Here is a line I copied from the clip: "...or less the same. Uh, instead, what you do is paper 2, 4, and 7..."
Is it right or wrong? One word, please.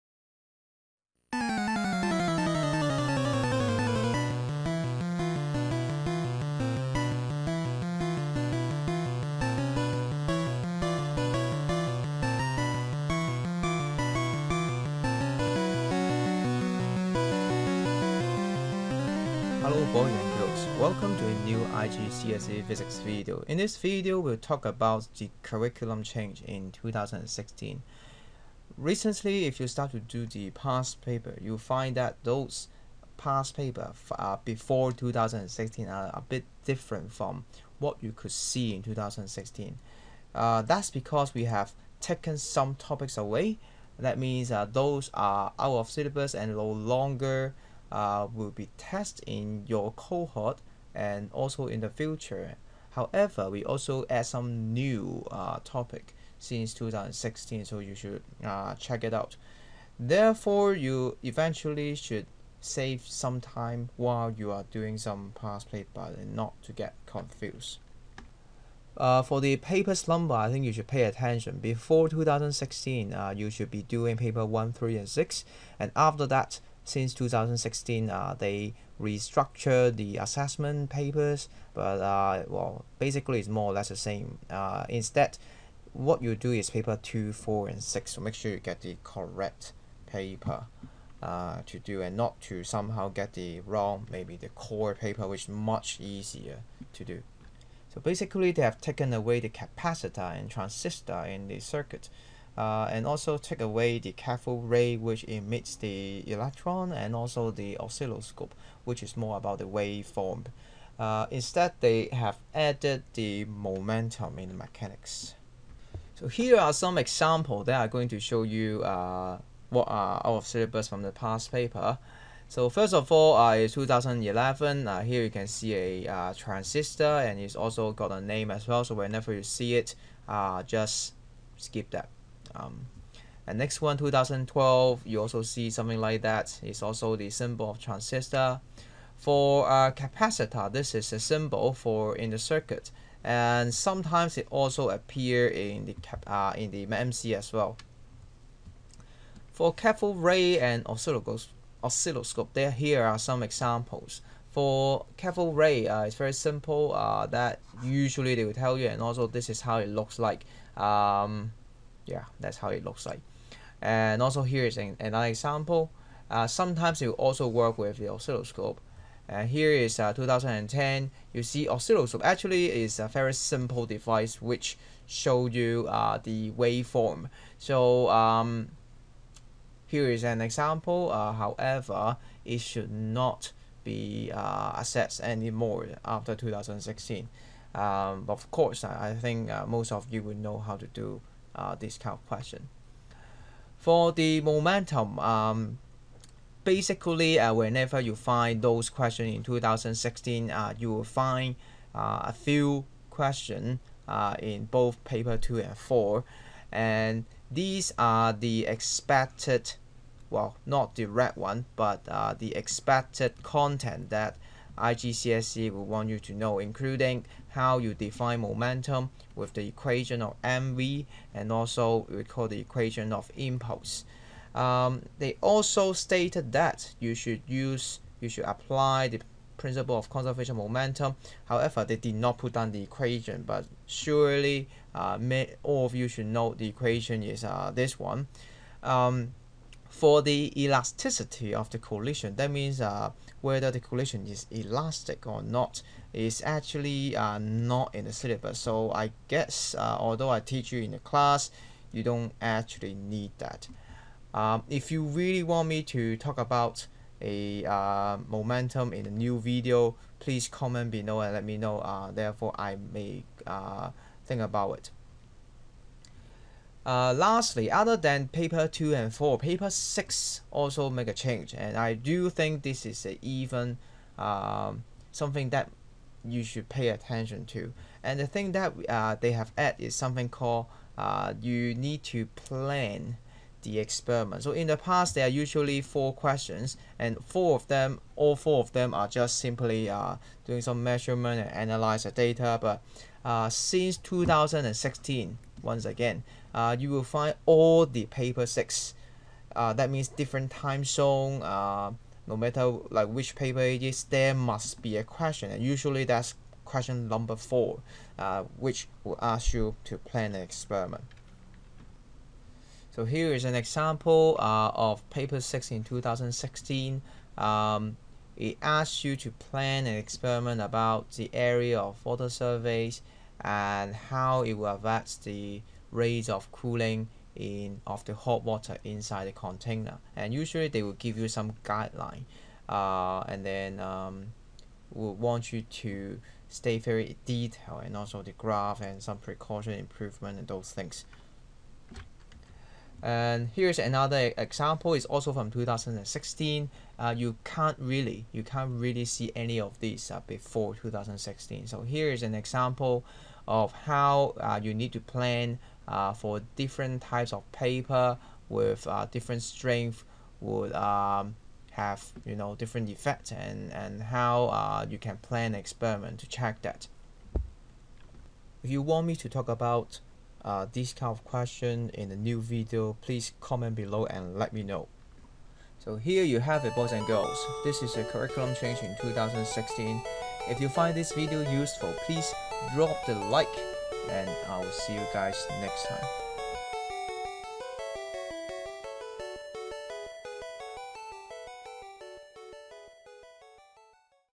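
wrong.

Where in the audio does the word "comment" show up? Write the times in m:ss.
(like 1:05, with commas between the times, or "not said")
4:20, 6:13.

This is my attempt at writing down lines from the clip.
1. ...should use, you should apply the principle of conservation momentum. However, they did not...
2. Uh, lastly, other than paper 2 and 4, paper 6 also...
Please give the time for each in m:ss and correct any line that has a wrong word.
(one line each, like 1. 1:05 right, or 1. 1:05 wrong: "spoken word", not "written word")
1. 3:47 right
2. 4:26 right.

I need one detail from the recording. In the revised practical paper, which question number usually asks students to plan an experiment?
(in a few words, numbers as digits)
question number 4.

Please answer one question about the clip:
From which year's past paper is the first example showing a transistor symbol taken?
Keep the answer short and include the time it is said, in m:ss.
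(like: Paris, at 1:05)
2011, at 2:03.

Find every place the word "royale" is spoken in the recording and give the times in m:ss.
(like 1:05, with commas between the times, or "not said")
not said.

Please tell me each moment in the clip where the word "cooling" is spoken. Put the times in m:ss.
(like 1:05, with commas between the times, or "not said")
5:26.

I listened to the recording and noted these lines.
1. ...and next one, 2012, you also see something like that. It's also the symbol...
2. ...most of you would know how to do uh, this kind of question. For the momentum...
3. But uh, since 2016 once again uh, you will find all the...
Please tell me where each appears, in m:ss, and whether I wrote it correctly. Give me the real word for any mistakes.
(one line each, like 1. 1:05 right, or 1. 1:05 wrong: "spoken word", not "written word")
1. 2:13 right
2. 3:09 right
3. 4:52 right.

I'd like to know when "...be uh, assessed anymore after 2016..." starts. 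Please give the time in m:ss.
3:03.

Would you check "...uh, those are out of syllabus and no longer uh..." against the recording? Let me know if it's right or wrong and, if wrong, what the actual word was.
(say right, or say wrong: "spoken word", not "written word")
right.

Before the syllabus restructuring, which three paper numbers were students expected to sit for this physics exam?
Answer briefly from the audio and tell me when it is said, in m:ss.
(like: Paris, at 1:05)
1, 3, and 6, at 1:14.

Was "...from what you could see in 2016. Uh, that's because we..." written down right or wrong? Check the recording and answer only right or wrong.
right.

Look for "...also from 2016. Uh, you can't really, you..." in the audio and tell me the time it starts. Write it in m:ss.
5:45.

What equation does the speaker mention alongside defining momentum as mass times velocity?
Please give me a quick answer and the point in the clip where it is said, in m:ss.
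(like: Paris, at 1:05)
impulse, at 3:43.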